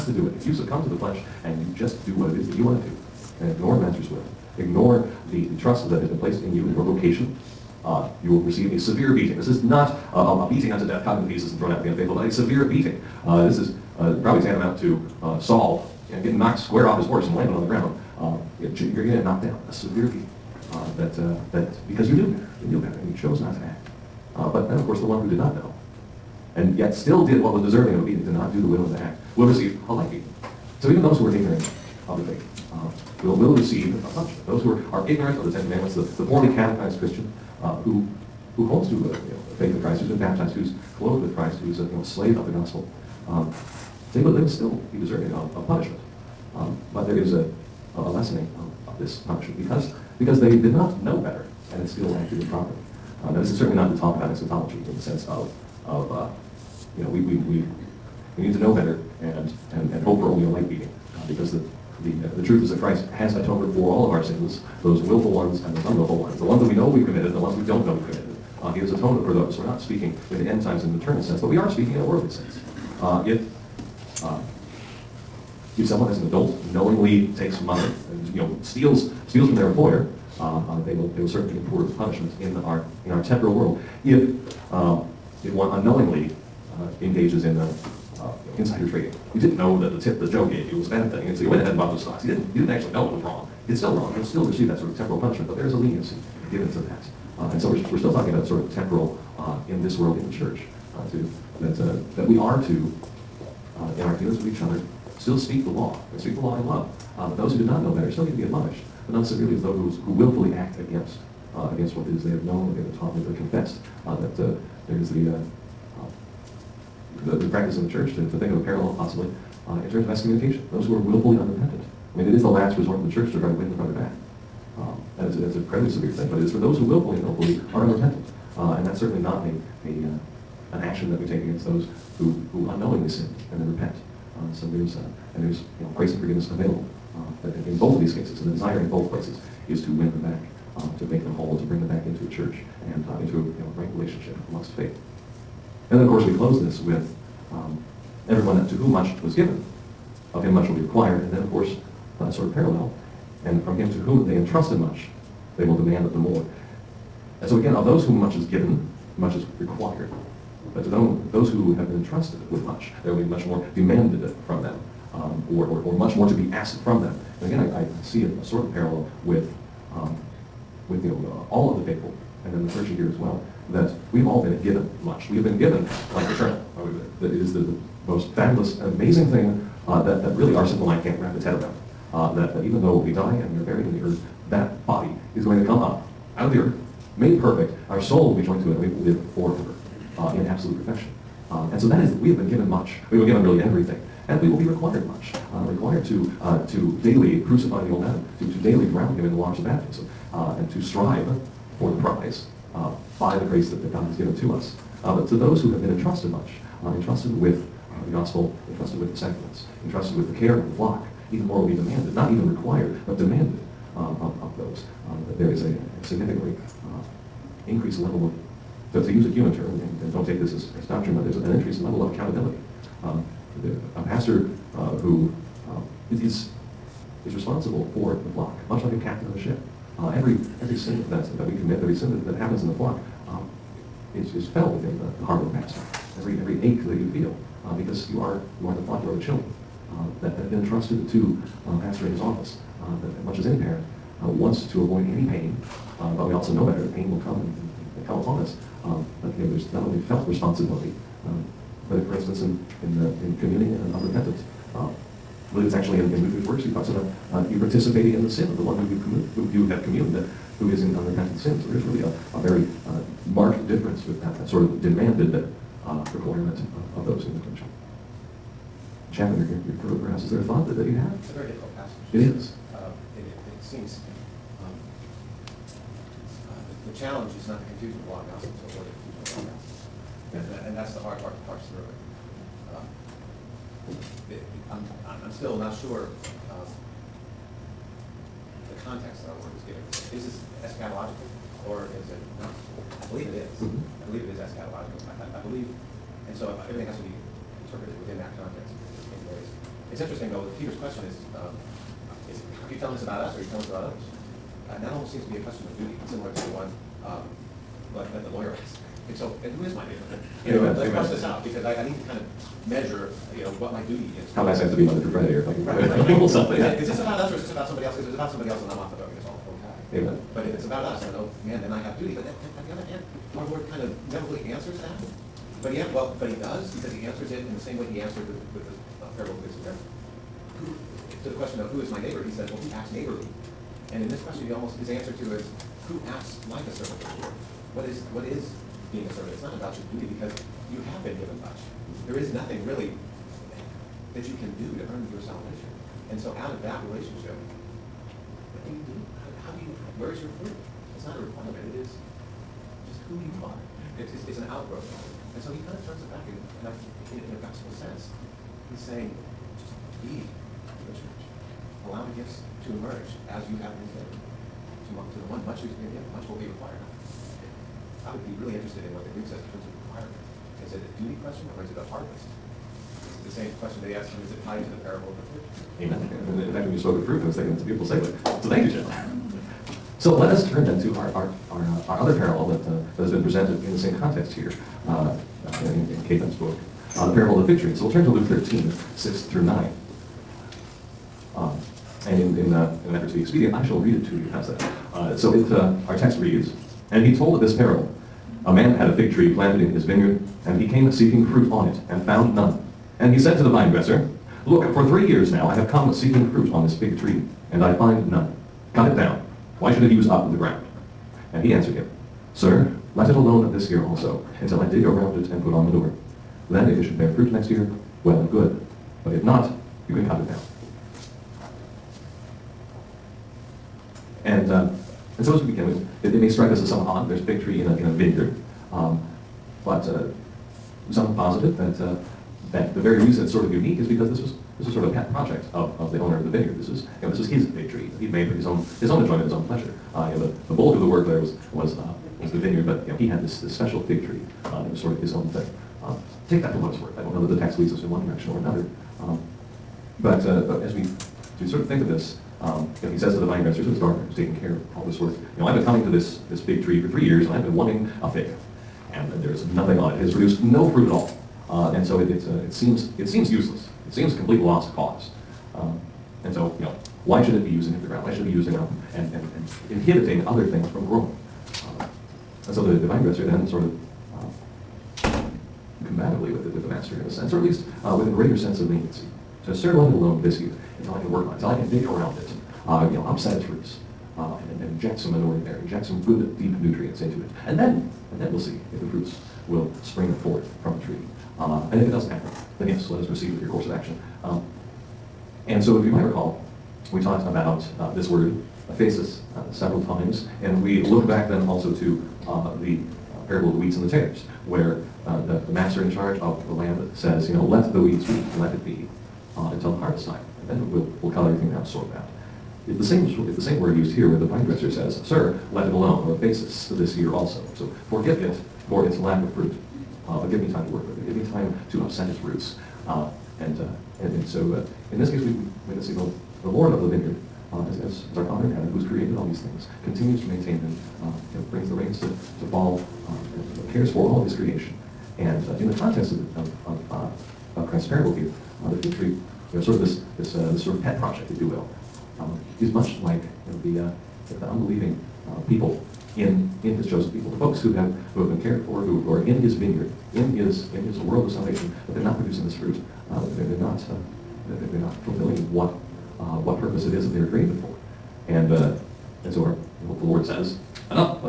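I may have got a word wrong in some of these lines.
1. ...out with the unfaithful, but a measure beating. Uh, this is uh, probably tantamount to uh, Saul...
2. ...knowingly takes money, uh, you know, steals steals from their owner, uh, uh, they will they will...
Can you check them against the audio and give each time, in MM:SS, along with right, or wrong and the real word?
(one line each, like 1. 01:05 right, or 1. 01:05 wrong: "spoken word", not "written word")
1. 00:11 wrong: "severe", not "measure"
2. 01:16 wrong: "employer", not "owner".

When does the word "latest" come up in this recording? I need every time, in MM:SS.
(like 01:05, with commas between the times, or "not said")
not said.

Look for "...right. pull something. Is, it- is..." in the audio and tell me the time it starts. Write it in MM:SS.
05:16.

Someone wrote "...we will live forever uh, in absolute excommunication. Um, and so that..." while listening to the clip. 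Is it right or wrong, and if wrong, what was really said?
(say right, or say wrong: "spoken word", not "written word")
wrong: "perfection", not "excommunication".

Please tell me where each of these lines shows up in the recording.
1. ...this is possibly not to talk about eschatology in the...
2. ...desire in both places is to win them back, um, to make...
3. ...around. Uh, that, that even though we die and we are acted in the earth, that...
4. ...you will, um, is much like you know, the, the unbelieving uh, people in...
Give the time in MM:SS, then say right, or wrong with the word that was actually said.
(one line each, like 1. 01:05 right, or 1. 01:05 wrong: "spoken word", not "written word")
1. 00:53 wrong: "certainly", not "possibly"
2. 02:18 right
3. 03:01 wrong: "buried", not "acted"
4. 09:01 right.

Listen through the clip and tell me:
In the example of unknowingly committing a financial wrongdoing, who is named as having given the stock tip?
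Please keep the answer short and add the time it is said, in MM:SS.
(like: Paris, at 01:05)
Joe, at 01:30.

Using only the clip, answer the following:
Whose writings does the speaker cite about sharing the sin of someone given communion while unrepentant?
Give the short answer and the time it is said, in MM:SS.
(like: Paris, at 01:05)
Luther's works, at 04:16.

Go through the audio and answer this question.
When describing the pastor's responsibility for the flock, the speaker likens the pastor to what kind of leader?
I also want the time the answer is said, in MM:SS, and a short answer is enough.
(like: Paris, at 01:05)
A captain of a ship, at 03:49.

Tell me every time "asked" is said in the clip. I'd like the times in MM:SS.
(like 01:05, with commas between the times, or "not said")
02:46, 05:08, 06:13.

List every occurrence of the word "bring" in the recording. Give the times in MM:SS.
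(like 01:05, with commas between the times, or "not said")
02:21, 08:51.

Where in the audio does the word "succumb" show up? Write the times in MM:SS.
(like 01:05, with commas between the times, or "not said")
00:00.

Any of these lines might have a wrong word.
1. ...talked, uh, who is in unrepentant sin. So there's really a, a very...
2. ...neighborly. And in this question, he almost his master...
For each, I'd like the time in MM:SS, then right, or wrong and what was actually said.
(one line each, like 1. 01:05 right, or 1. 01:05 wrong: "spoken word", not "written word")
1. 04:19 wrong: "communed", not "talked"
2. 05:32 wrong: "answer", not "master".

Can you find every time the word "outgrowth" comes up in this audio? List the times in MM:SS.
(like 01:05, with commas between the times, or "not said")
05:54.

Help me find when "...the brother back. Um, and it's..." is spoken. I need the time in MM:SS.
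02:03.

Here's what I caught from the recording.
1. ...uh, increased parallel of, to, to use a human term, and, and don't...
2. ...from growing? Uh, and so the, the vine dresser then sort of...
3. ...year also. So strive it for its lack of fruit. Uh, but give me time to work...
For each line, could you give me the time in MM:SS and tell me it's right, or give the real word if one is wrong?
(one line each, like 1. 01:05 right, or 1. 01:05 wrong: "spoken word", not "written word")
1. 03:36 wrong: "level", not "parallel"
2. 07:50 right
3. 08:36 wrong: "forgive", not "strive".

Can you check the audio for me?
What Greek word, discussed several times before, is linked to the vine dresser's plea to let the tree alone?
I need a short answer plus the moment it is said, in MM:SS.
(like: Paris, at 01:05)
Aphesis, at 08:18.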